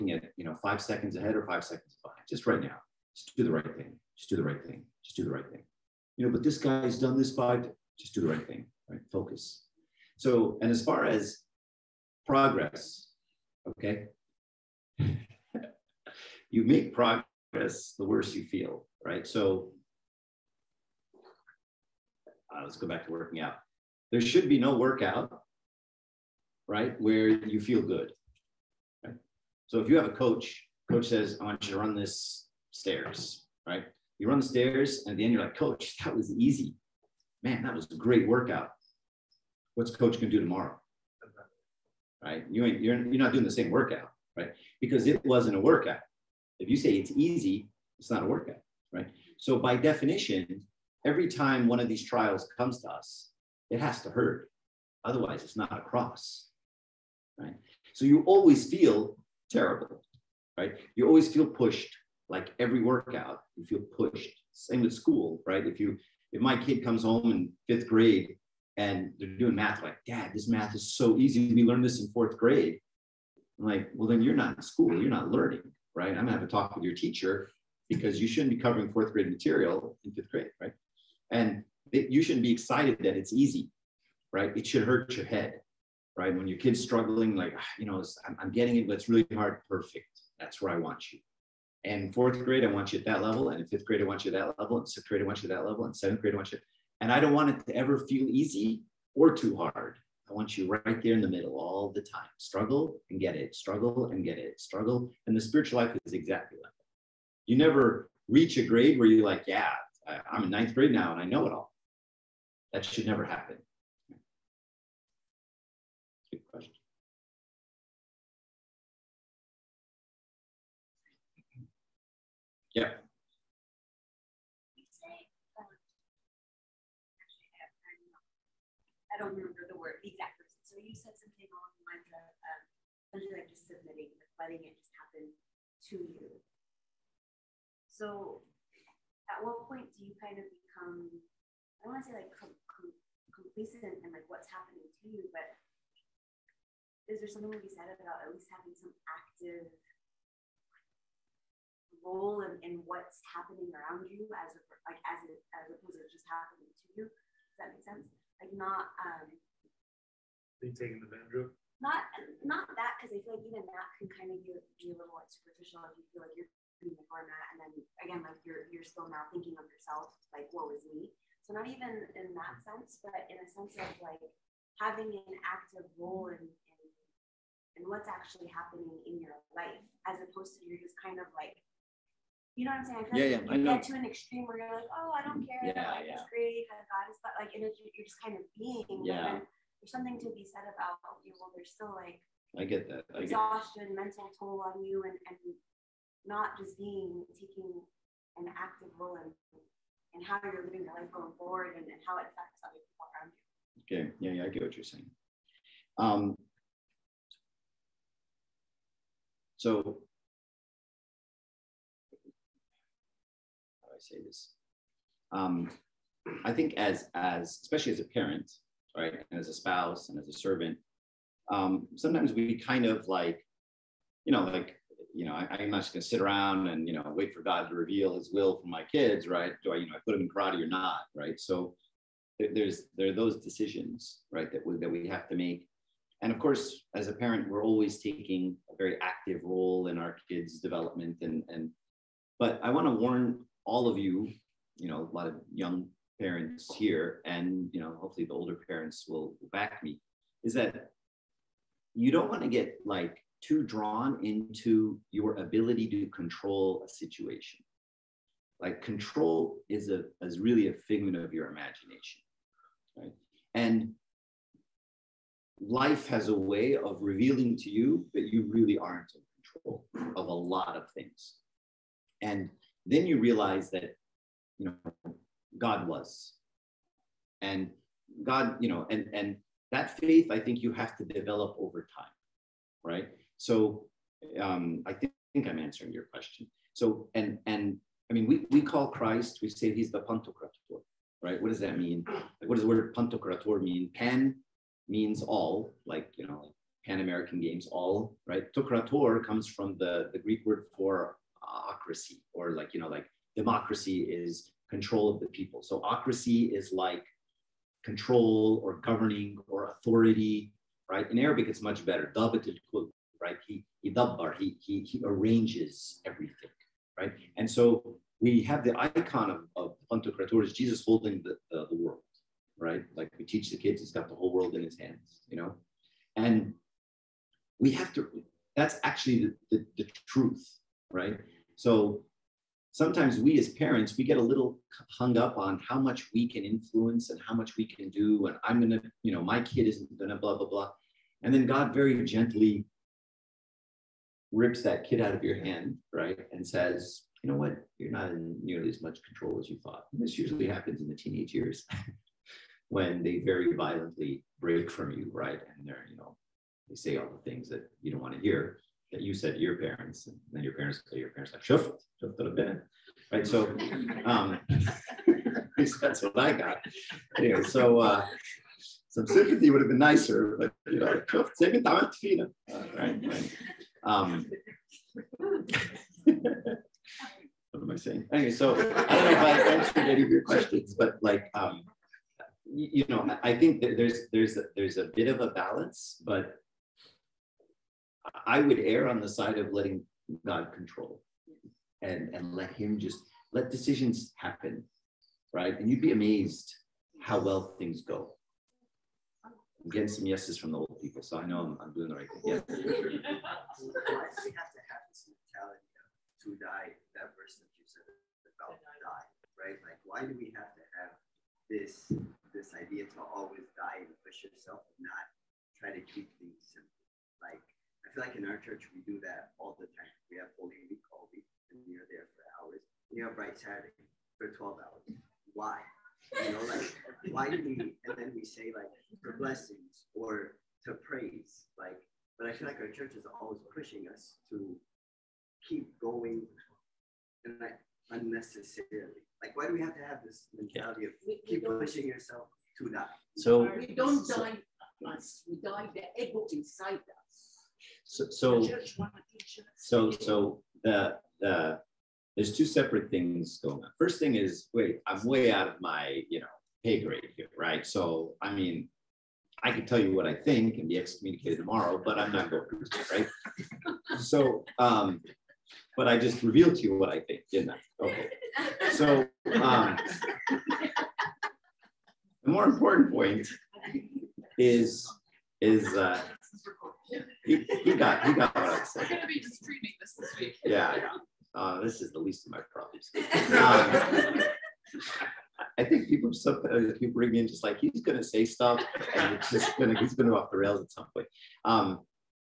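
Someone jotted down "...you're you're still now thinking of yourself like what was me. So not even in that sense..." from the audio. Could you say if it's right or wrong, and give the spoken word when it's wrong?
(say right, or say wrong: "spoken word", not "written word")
right.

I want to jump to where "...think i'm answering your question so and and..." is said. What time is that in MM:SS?
04:45.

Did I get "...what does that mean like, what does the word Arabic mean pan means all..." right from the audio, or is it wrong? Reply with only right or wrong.
wrong.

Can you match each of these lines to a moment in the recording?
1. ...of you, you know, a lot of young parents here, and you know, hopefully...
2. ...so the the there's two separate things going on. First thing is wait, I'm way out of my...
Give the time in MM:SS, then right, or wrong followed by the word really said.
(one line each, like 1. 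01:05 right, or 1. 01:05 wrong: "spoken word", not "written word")
1. 04:03 right
2. 07:29 right.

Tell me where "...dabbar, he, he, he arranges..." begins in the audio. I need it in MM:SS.
05:13.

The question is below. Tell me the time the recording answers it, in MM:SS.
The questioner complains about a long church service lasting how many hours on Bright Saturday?
07:04.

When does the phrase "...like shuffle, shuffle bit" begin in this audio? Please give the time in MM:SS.
06:01.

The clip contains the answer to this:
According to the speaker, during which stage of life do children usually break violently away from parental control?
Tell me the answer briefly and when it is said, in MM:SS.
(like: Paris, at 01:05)
teenage years, at 05:50.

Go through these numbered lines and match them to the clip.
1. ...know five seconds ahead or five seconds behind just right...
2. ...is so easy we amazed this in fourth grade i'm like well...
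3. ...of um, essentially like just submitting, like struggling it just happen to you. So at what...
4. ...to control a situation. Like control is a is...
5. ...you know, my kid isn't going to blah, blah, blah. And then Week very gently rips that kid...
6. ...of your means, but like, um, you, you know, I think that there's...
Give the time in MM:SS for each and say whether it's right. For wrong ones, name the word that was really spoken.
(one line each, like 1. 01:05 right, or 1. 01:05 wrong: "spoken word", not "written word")
1. 00:00 right
2. 01:10 wrong: "learned", not "amazed"
3. 02:12 wrong: "letting", not "struggling"
4. 04:15 right
5. 05:39 wrong: "God", not "Week"
6. 06:20 wrong: "questions", not "means".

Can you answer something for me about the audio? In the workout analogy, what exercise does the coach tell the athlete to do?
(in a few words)
run the stairs.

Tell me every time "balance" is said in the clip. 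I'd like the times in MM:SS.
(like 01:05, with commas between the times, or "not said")
06:25.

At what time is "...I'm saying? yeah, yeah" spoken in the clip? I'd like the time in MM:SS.
03:02.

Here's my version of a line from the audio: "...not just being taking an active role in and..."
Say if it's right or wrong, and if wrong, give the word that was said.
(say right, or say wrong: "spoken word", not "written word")
right.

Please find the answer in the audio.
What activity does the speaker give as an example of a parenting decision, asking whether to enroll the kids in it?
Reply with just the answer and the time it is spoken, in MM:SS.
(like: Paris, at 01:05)
karate, at 03:50.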